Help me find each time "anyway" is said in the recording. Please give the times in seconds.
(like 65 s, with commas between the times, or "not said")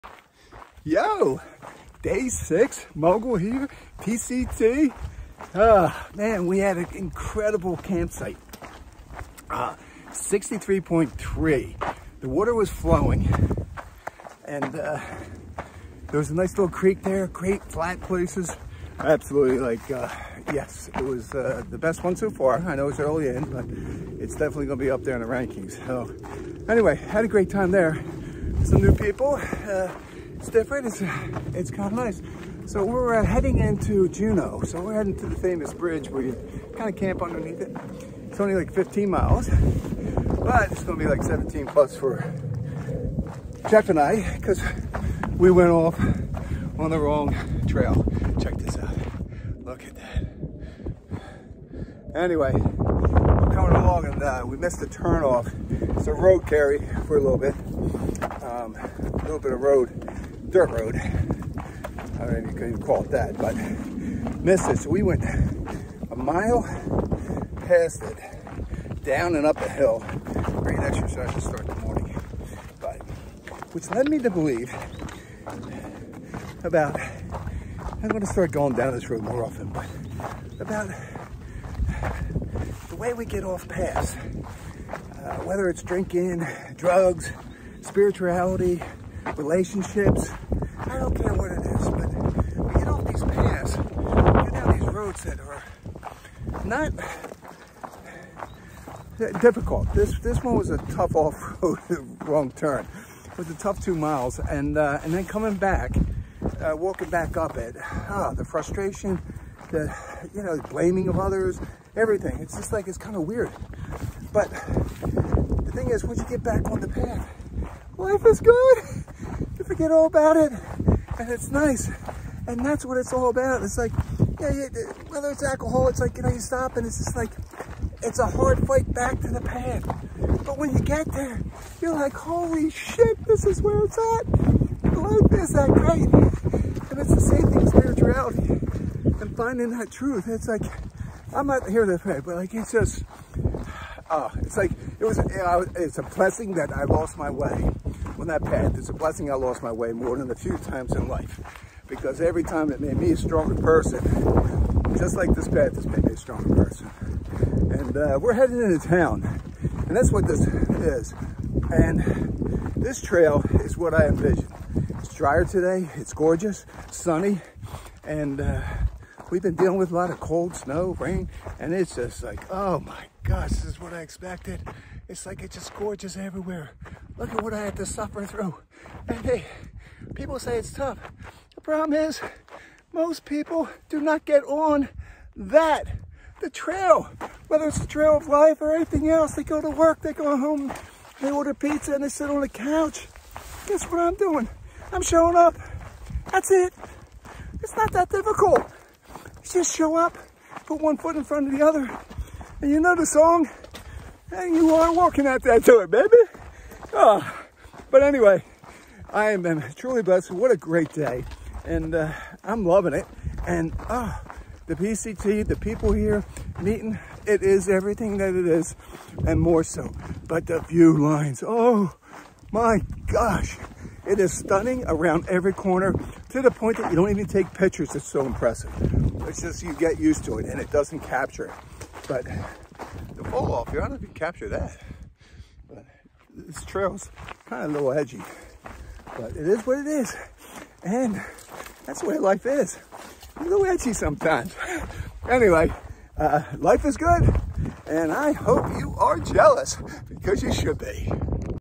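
26 s, 52 s, 208 s, 245 s.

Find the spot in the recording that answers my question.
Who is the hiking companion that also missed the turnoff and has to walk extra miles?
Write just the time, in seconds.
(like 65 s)
43 s.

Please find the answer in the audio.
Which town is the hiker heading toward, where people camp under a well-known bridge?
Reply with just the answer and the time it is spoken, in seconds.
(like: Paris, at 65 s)
Julian, at 34 s.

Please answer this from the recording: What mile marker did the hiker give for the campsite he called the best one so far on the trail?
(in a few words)
63.3.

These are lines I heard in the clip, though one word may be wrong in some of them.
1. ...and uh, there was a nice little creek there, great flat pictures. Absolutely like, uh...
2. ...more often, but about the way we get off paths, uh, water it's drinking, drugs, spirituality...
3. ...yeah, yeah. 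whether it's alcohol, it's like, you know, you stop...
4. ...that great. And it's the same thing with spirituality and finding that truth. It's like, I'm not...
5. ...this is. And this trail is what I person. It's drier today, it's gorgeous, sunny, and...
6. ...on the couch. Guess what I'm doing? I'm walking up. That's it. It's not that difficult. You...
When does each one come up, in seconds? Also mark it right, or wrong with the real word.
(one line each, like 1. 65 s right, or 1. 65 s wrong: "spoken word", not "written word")
1. 14 s wrong: "places", not "pictures"
2. 79 s wrong: "whether", not "water"
3. 124 s right
4. 135 s right
5. 160 s wrong: "envision", not "person"
6. 192 s wrong: "showing", not "walking".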